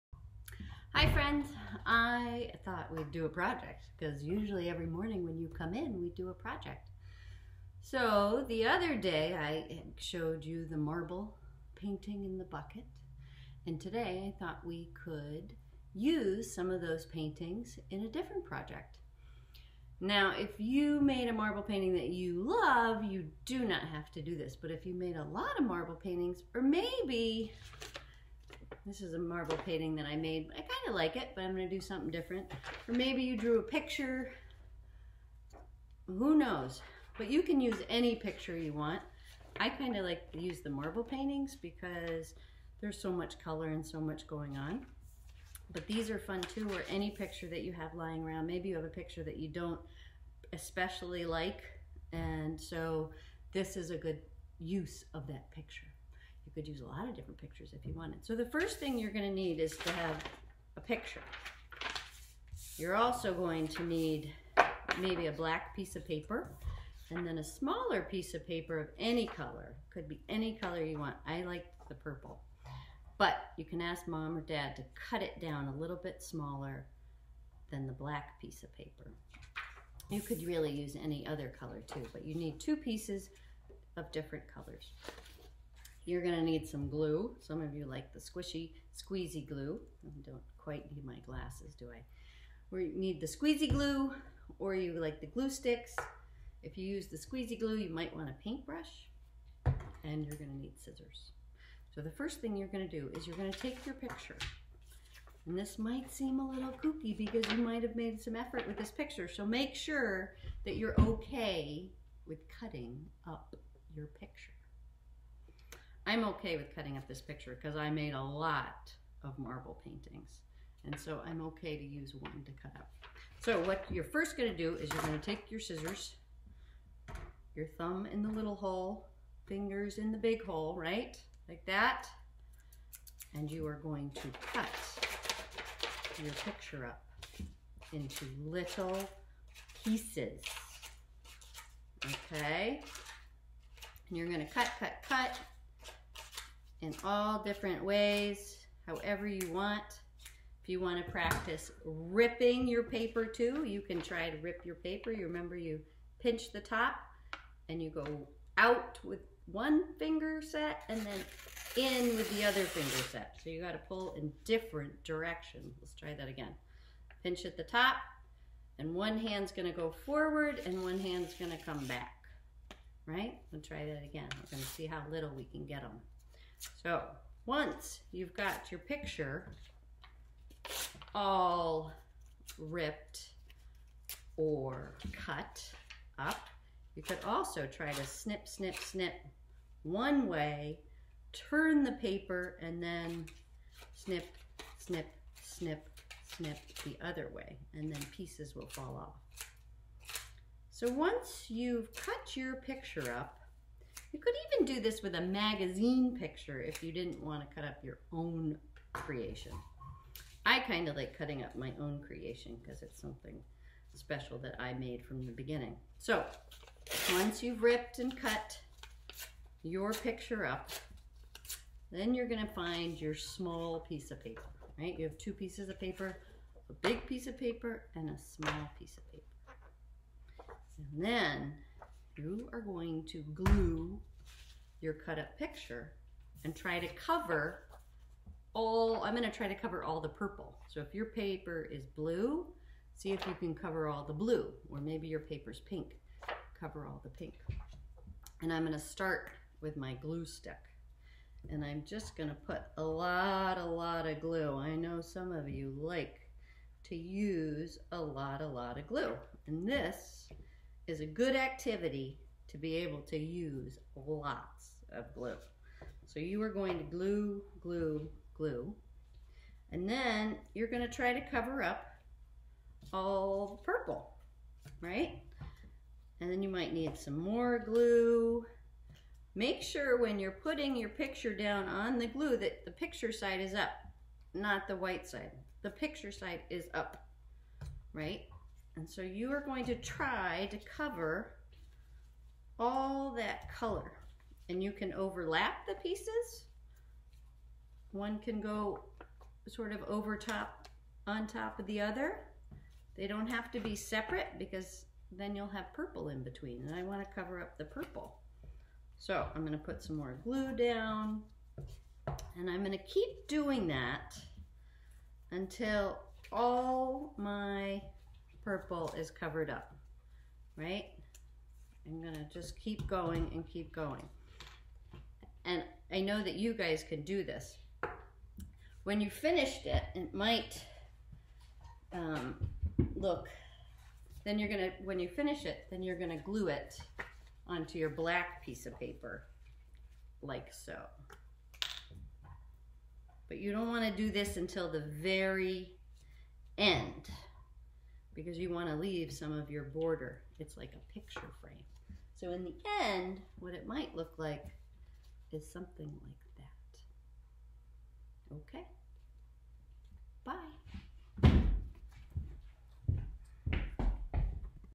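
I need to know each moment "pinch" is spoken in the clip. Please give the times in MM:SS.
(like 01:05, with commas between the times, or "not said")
02:36, 02:47.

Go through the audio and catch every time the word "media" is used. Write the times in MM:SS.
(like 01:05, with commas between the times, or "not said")
not said.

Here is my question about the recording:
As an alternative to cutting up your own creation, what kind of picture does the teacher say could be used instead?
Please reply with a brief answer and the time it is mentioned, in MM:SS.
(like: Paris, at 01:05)
a magazine picture, at 03:25.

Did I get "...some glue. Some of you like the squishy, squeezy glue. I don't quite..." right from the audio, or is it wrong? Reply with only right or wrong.
right.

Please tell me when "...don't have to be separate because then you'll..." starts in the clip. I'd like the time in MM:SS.
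05:03.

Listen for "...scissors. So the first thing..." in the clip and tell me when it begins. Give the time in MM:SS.
01:40.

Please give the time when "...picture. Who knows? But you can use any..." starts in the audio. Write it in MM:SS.
00:33.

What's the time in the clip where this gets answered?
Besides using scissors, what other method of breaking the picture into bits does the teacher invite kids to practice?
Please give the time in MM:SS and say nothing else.
02:34.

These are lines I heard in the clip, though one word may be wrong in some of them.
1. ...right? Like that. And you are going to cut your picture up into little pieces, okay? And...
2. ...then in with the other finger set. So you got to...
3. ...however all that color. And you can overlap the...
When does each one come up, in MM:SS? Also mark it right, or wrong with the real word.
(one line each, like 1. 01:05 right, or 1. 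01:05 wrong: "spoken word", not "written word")
1. 02:10 right
2. 02:41 right
3. 04:50 wrong: "cover", not "however".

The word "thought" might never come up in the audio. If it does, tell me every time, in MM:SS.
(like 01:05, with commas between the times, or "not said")
00:02, 00:14.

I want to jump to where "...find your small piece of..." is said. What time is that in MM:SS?
03:42.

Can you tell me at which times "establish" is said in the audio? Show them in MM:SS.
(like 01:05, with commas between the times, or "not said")
not said.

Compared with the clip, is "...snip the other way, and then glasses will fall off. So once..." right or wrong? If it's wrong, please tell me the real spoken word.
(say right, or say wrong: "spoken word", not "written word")
wrong: "pieces", not "glasses".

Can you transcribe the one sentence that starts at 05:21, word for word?
I'm gonna just keep going and keep going.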